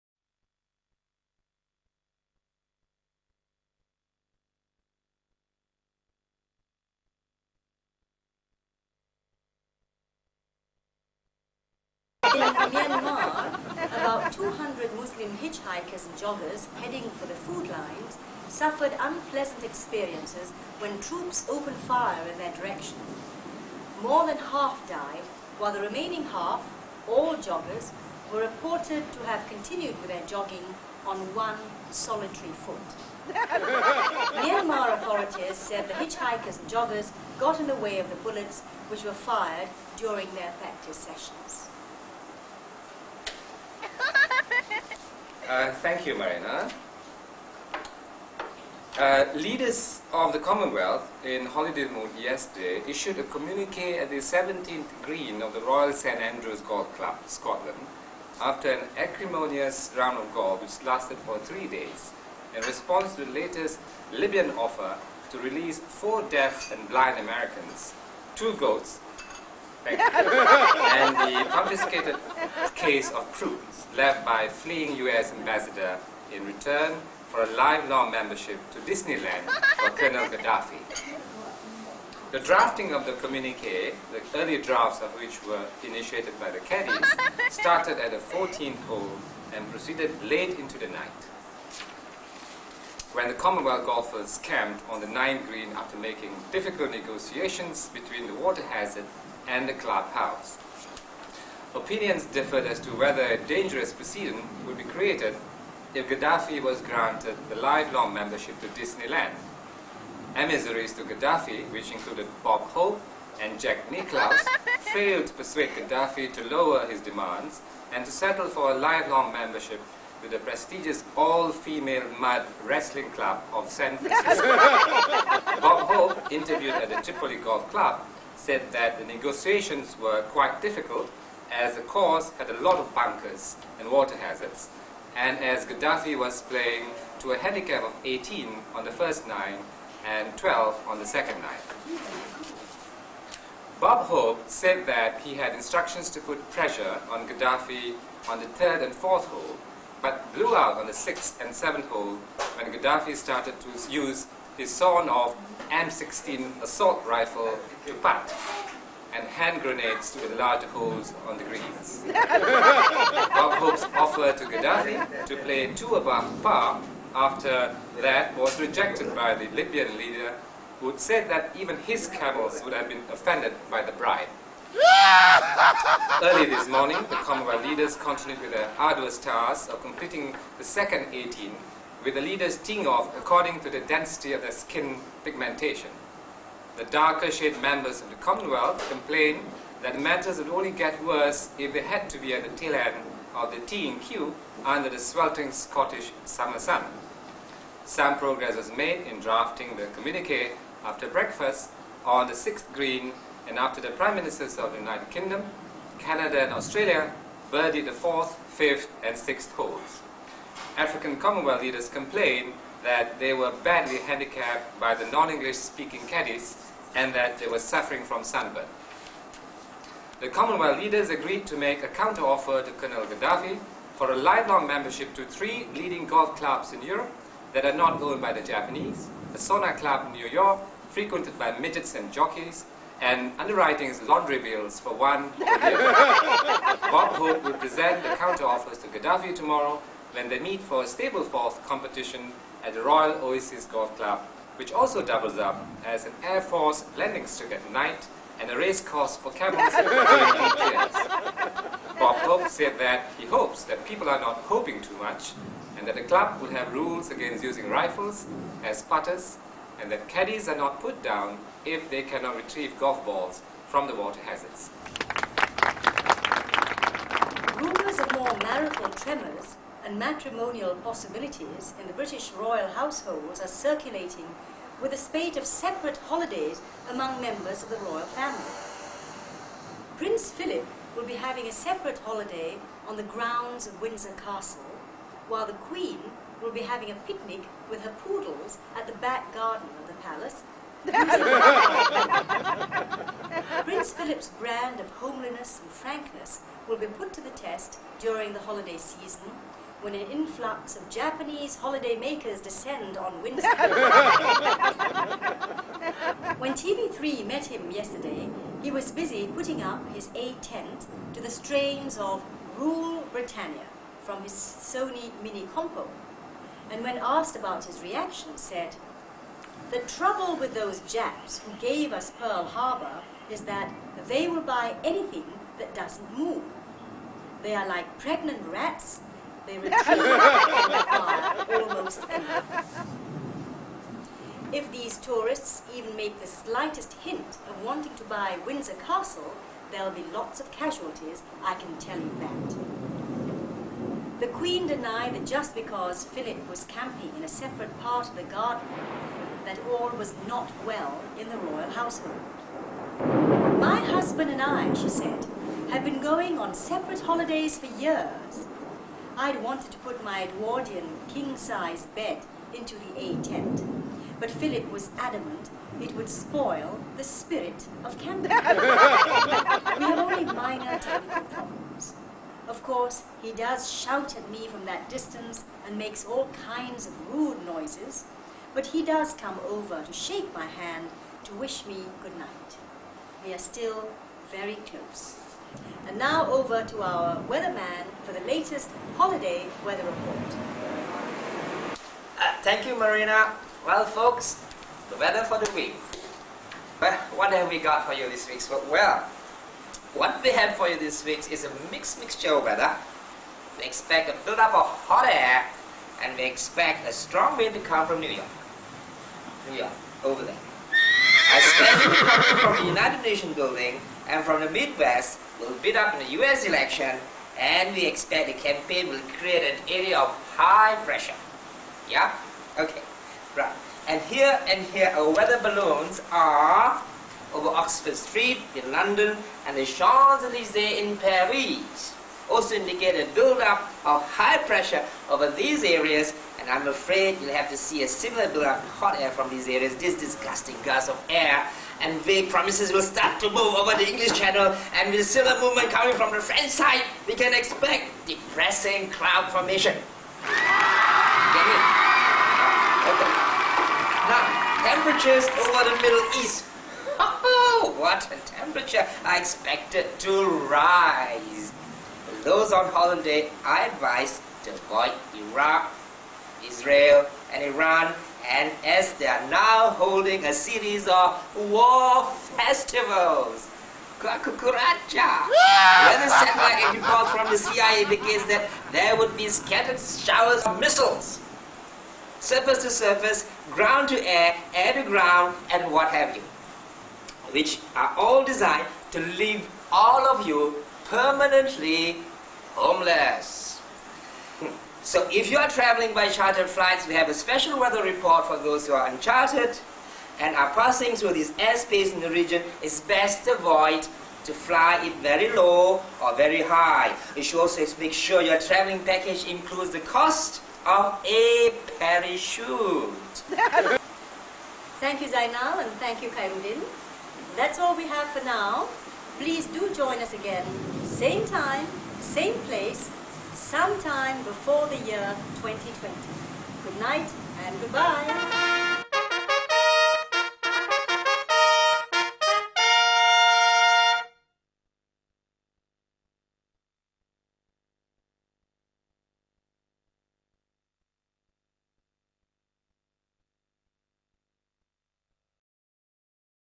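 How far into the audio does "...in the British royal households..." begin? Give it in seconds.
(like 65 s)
271 s.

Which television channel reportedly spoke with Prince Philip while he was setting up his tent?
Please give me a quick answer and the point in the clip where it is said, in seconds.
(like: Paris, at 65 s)
TV3, at 306 s.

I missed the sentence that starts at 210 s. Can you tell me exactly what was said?
African Commonwealth leaders complained that they were badly handicapped by the non-English speaking caddies and that they were suffering from sunburn.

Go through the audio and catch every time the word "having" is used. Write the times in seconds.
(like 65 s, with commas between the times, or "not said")
281 s, 286 s.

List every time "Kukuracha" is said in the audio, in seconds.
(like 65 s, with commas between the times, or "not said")
473 s.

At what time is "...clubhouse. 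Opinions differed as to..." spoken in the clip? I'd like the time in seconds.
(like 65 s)
99 s.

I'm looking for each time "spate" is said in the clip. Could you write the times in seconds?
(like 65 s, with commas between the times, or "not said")
274 s.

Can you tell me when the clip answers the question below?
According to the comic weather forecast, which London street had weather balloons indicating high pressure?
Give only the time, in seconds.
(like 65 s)
427 s.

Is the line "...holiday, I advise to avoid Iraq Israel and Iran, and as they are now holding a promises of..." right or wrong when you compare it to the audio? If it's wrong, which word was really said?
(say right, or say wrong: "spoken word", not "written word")
wrong: "series", not "promises".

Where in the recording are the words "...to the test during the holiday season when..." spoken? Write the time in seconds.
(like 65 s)
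297 s.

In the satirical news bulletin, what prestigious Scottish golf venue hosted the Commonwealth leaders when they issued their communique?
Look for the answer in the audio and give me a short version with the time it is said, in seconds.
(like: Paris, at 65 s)
Royal St Andrews Golf Club, at 55 s.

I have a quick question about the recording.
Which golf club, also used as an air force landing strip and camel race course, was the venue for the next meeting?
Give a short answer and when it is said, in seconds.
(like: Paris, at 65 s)
Royal Oasis Golf Club, at 242 s.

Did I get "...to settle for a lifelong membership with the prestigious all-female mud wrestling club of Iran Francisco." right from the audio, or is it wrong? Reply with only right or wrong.
wrong.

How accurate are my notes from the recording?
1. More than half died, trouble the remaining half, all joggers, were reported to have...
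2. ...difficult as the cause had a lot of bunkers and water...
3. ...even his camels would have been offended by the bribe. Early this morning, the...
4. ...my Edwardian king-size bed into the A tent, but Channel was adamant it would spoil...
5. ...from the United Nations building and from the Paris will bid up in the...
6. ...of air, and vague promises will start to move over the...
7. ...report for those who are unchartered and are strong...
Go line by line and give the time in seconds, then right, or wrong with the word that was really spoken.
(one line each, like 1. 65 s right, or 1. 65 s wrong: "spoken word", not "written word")
1. 24 s wrong: "while", not "trouble"
2. 130 s right
3. 171 s right
4. 360 s wrong: "Philip", not "Channel"
5. 412 s wrong: "Midwest", not "Paris"
6. 440 s right
7. 497 s wrong: "passing", not "strong".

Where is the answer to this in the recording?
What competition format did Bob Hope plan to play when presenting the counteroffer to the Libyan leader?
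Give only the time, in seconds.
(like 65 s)
240 s.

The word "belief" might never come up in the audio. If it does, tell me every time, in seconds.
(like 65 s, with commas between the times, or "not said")
not said.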